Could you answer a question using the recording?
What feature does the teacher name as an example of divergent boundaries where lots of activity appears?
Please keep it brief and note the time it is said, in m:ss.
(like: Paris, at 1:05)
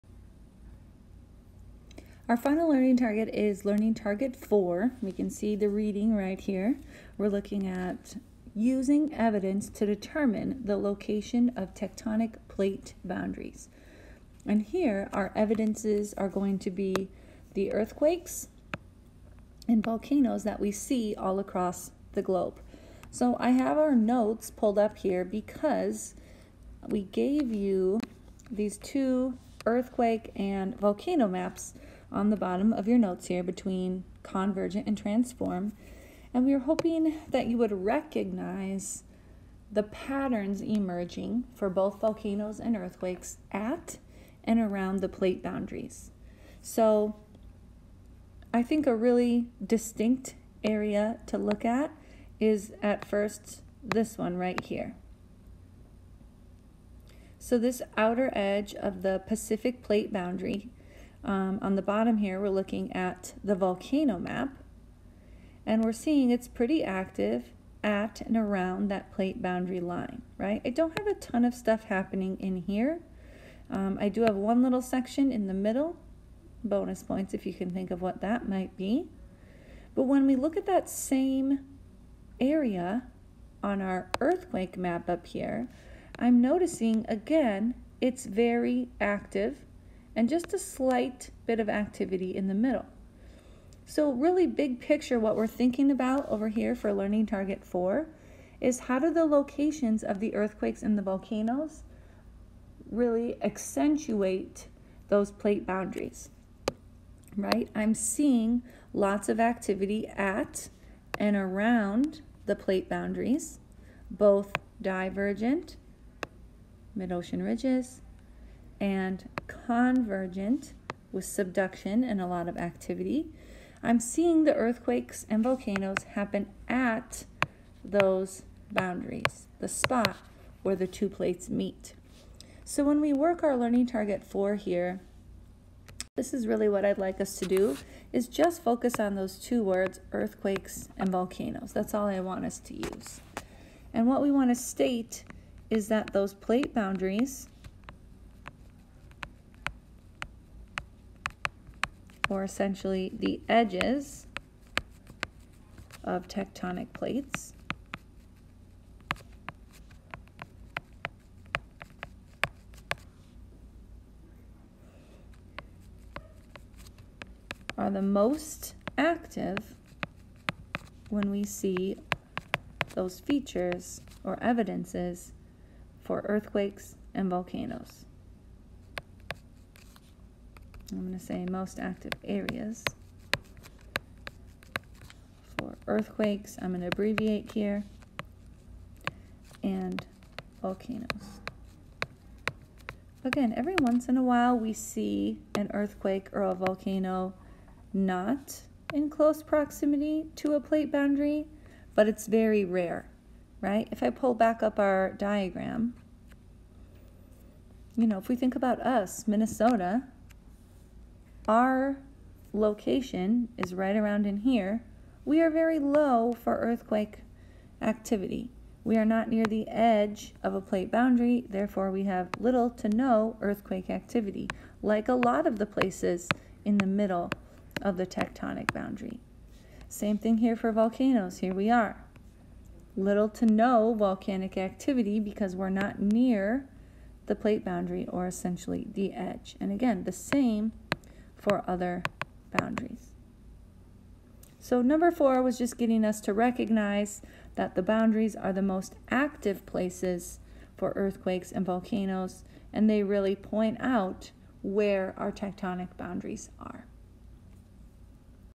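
Mid-ocean ridges, at 1:56.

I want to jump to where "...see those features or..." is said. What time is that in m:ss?
2:51.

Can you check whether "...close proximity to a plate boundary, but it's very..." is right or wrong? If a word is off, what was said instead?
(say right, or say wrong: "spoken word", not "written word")
right.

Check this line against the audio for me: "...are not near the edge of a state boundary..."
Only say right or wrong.
wrong.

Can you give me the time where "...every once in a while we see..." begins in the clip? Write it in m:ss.
3:13.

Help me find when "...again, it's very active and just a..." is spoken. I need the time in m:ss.
1:27.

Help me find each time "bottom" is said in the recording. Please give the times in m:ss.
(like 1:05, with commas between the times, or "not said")
0:32, 1:01.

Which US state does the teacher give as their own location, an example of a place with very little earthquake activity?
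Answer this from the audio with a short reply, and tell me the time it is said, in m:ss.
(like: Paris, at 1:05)
Minnesota, at 3:29.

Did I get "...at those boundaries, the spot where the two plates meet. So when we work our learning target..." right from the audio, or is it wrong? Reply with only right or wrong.
right.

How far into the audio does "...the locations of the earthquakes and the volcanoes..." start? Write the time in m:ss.
1:39.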